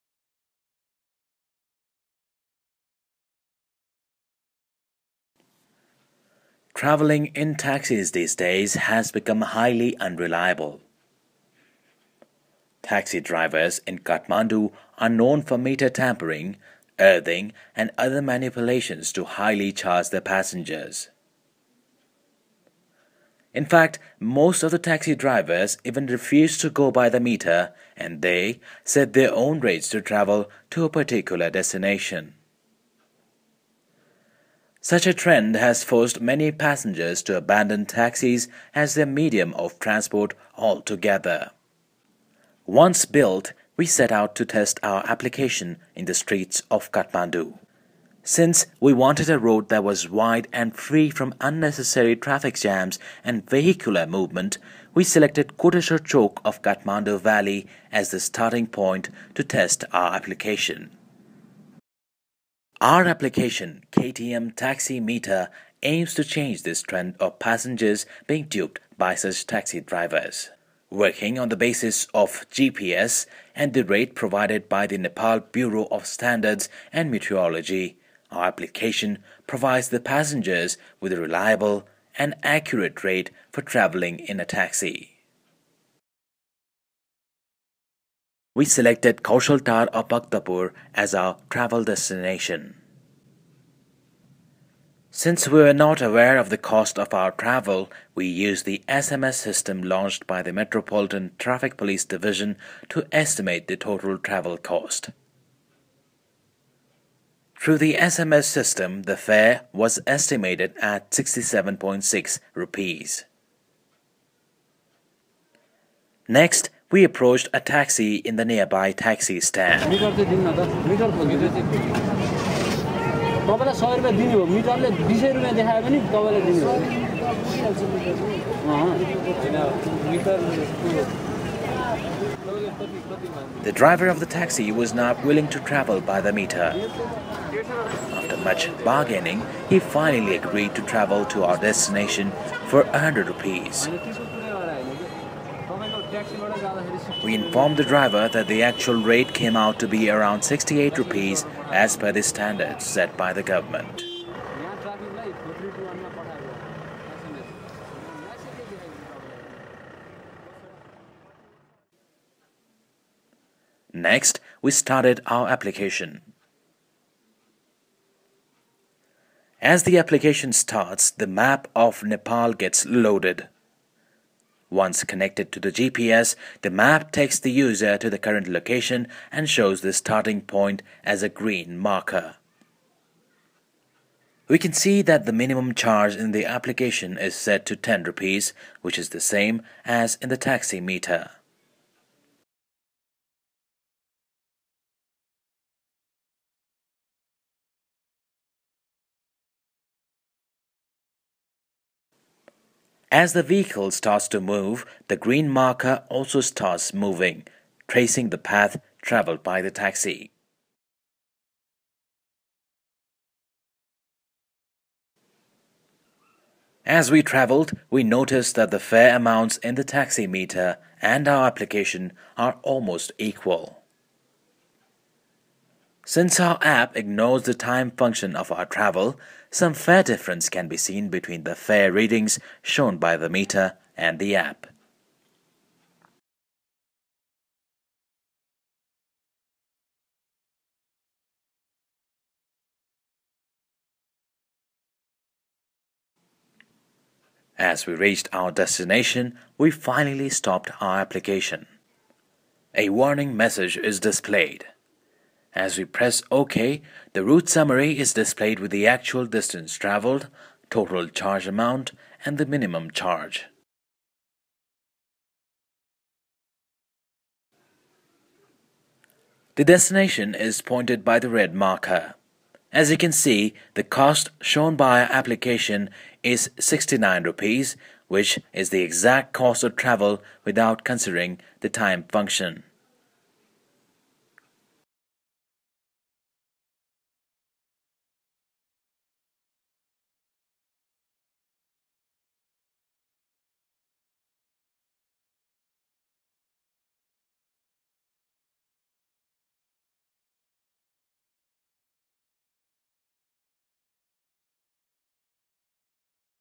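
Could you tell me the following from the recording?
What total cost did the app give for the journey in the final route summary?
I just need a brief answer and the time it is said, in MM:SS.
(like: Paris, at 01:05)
69 rupees, at 04:36.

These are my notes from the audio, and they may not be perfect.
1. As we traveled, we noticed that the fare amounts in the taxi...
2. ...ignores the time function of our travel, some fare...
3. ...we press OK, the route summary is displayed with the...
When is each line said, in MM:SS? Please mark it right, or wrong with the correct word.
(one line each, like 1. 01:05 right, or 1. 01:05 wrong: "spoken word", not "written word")
1. 03:36 right
2. 03:46 right
3. 04:15 right.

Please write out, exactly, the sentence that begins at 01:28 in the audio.
we selected Kaushaltar or Bhaktapur as our travel destination.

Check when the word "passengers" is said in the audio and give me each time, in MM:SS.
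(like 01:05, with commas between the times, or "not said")
00:20, 00:36, 01:07, 01:19.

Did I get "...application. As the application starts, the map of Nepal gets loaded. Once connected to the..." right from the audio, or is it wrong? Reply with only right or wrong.
right.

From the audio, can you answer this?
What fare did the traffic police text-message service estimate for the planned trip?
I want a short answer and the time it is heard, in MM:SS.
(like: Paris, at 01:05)
67.6 rupees, at 01:51.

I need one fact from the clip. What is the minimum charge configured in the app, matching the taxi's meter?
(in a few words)
10 rupees.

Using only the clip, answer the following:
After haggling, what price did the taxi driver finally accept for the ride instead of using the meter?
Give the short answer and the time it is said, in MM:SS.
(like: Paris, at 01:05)
100 rupees, at 02:22.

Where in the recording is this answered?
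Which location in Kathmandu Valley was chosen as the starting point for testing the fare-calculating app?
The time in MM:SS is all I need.
00:55.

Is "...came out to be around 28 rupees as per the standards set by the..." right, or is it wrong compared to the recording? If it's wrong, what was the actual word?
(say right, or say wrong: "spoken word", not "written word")
wrong: "68", not "28".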